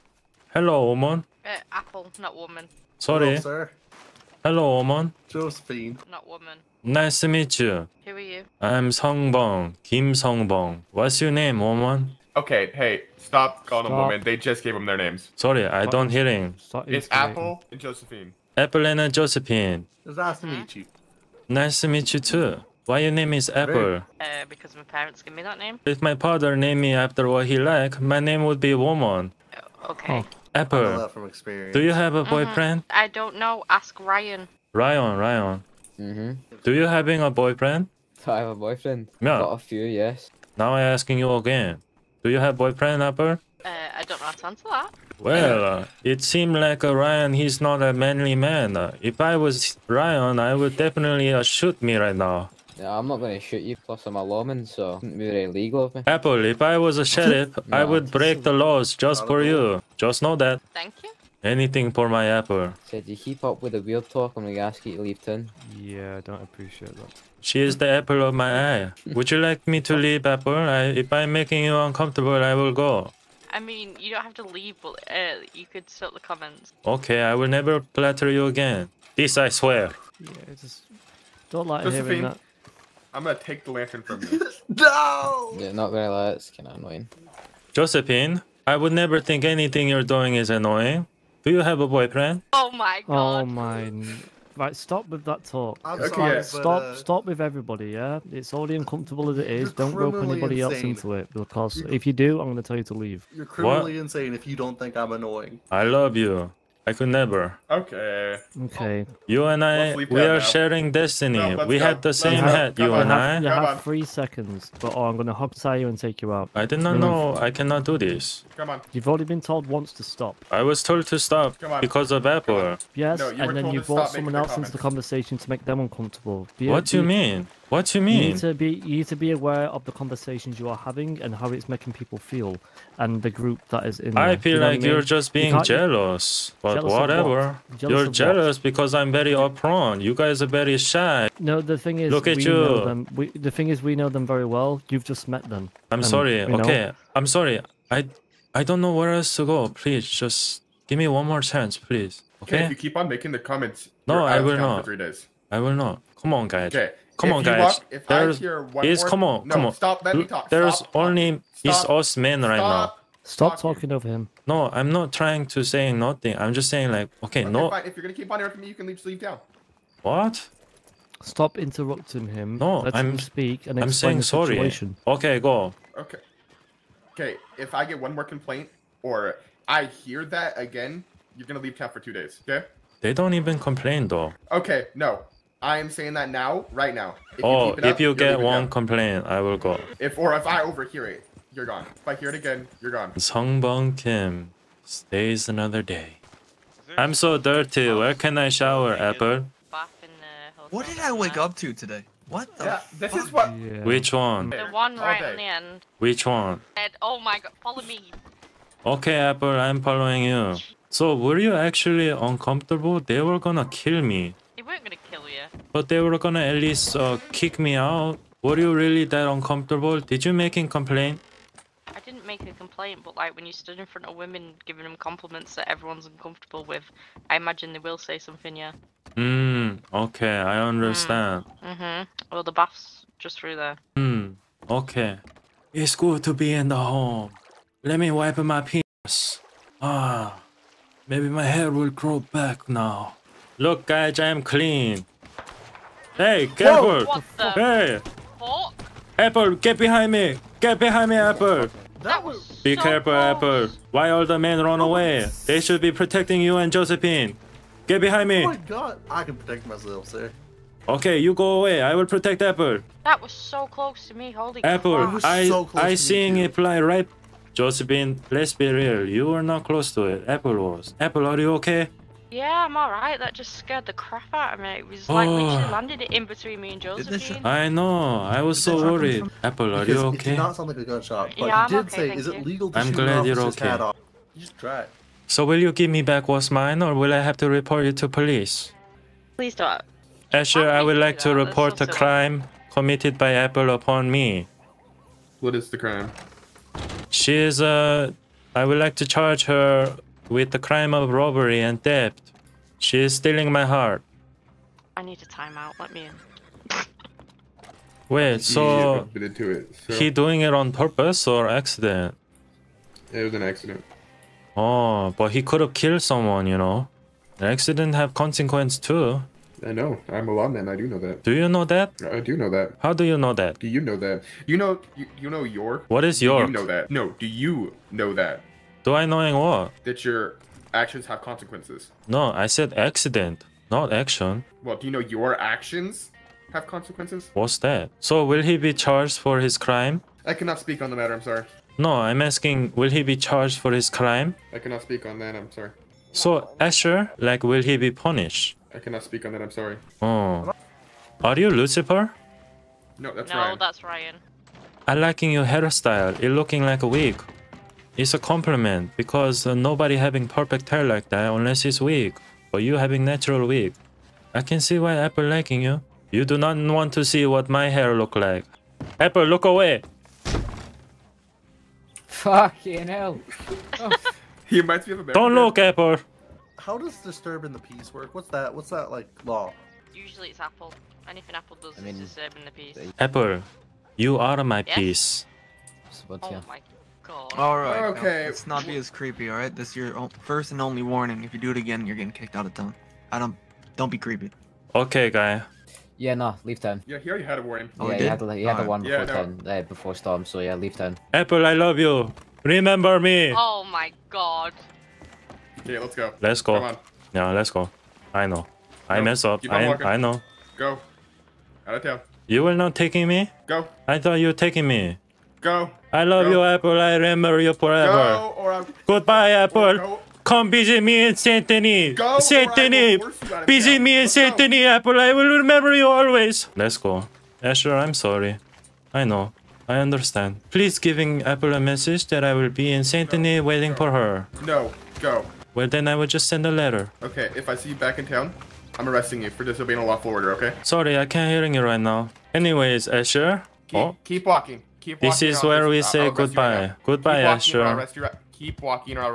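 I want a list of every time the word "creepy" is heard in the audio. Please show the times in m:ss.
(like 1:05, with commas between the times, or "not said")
6:28, 6:33.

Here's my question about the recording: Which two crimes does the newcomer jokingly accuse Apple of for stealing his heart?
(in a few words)
robbery and theft.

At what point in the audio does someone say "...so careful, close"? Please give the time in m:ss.
4:12.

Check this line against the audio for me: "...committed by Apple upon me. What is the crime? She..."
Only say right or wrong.
right.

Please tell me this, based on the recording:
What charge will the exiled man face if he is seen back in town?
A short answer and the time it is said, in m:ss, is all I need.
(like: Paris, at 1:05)
disobeying a lawful order, at 7:19.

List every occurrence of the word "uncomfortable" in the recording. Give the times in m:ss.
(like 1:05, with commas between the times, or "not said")
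1:11, 1:38, 2:05, 3:32, 3:39, 3:46.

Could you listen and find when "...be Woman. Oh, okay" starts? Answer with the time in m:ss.
0:28.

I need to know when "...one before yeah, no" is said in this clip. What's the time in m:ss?
6:38.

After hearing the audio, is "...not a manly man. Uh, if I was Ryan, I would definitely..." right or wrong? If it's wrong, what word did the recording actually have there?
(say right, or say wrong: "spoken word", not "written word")
right.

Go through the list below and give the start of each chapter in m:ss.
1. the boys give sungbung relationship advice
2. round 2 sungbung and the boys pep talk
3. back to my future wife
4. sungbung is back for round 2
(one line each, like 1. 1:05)
1. 1:46
2. 6:34
3. 3:15
4. 4:02.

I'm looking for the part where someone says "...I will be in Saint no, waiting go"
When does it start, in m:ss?
7:12.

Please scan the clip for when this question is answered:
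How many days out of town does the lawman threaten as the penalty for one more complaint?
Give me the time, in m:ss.
3:01.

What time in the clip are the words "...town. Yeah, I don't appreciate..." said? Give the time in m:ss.
1:05.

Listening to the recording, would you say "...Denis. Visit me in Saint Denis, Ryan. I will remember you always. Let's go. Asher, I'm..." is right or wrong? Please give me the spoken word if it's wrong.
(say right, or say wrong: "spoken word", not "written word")
wrong: "Apple", not "Ryan".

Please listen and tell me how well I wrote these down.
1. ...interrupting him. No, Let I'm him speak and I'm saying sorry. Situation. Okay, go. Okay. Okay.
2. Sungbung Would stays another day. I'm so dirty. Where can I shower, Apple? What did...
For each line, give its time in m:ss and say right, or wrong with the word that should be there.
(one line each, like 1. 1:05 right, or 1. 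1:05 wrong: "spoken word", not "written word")
1. 2:51 right
2. 3:13 wrong: "Kim", not "Would".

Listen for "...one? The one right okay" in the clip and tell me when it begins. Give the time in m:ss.
3:24.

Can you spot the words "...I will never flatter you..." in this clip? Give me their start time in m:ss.
1:17.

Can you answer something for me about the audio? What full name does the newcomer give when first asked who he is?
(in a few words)
Kim Sung Bung.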